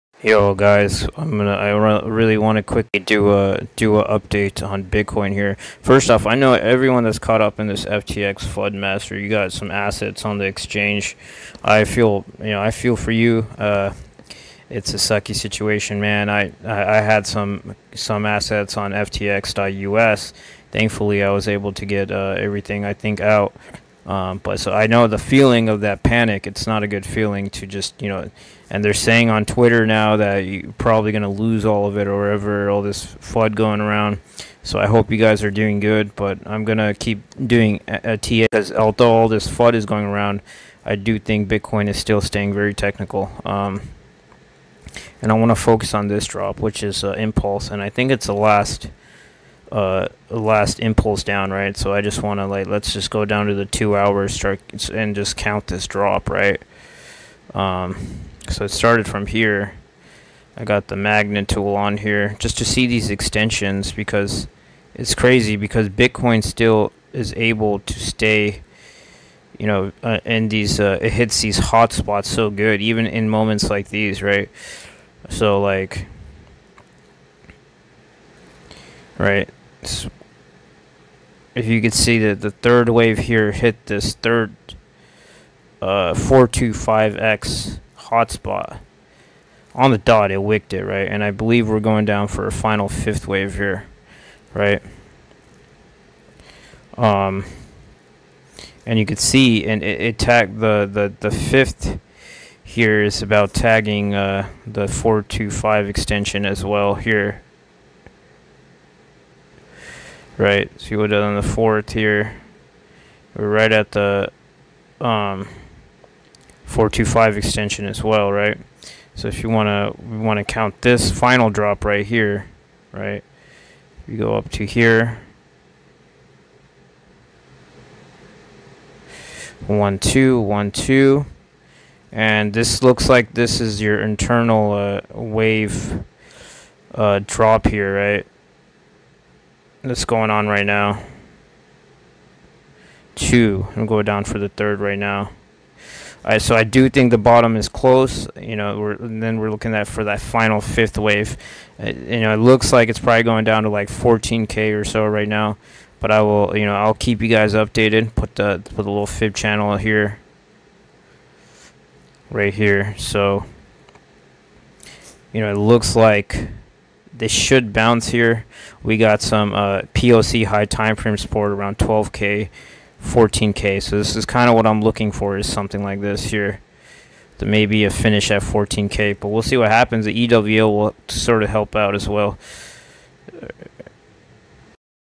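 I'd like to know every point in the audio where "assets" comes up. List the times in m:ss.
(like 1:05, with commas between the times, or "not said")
0:09, 0:18.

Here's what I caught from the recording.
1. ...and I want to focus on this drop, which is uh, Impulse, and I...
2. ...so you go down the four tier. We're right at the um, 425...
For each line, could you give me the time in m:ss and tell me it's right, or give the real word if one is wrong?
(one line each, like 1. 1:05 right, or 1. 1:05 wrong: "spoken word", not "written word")
1. 0:45 right
2. 1:50 right.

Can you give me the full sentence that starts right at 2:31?
Uh, you know, it looks like it's probably going down to like 14k or so right now.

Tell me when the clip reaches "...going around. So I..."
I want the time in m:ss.
0:33.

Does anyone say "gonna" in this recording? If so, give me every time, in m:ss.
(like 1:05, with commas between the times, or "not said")
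0:01, 0:36.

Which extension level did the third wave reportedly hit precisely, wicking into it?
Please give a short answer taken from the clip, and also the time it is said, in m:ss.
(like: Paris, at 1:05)
425, at 1:26.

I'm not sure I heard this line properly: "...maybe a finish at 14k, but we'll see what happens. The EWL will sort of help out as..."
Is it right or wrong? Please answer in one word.
right.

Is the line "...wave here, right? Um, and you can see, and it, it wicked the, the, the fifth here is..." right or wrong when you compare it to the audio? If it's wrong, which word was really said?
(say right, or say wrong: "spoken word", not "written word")
wrong: "tagged", not "wicked".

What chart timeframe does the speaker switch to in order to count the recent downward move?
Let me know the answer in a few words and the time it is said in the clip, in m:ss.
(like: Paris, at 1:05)
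Two hours, at 0:53.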